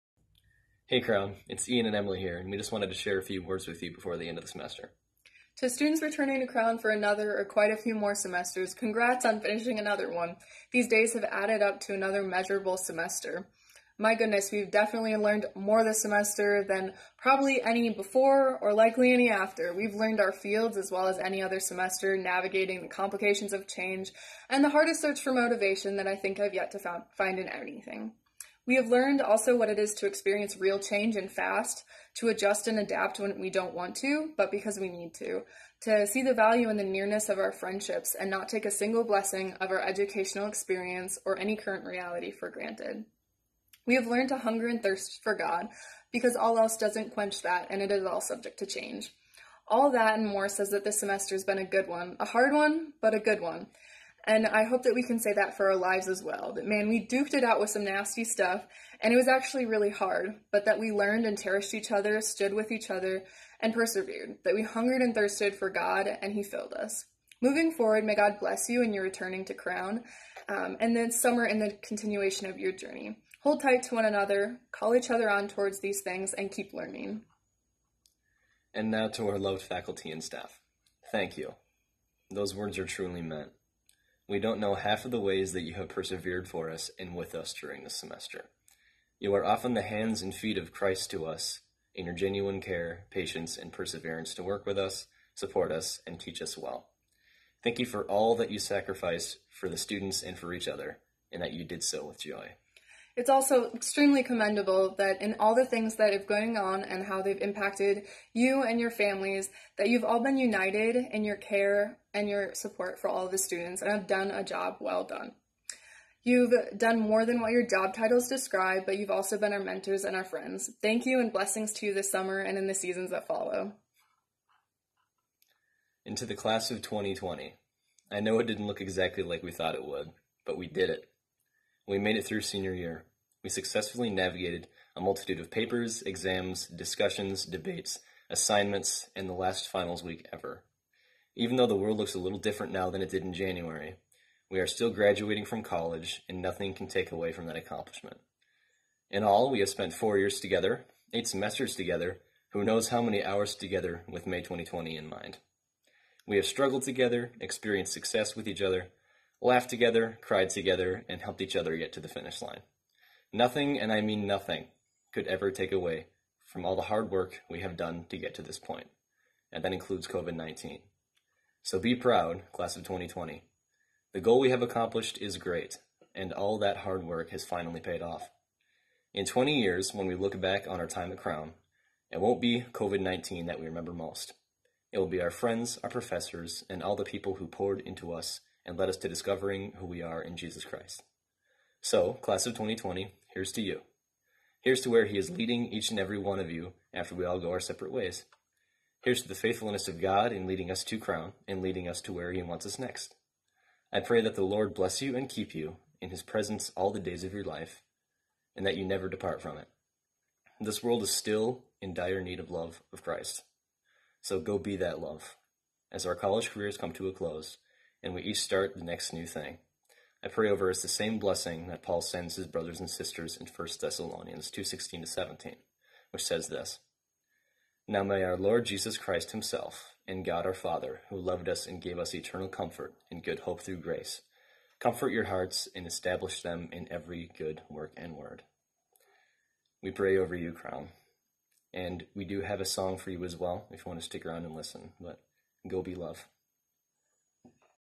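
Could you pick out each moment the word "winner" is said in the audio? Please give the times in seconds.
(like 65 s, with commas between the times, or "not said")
not said.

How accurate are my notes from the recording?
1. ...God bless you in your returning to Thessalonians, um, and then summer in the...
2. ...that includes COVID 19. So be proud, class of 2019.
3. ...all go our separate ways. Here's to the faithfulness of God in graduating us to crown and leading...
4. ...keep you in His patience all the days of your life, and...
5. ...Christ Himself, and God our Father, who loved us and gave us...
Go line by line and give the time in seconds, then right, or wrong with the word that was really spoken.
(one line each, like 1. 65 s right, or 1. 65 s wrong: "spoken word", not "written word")
1. 68 s wrong: "Crown", not "Thessalonians"
2. 169 s wrong: "2020", not "2019"
3. 197 s wrong: "leading", not "graduating"
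4. 205 s wrong: "presence", not "patience"
5. 228 s right.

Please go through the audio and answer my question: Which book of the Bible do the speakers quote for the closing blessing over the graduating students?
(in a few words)
1 Thessalonians.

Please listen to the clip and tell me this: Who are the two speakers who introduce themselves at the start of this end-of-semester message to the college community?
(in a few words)
Ian and Emily.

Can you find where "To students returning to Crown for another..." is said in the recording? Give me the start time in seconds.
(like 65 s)
5 s.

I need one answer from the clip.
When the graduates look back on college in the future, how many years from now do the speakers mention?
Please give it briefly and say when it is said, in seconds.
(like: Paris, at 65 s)
20 years, at 179 s.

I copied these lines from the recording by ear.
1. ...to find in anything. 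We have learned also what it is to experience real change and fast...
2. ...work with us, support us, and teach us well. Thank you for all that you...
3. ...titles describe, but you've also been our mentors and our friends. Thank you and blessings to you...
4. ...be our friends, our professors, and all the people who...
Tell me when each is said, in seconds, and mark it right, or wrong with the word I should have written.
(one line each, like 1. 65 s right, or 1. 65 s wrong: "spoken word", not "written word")
1. 26 s right
2. 94 s right
3. 117 s right
4. 185 s right.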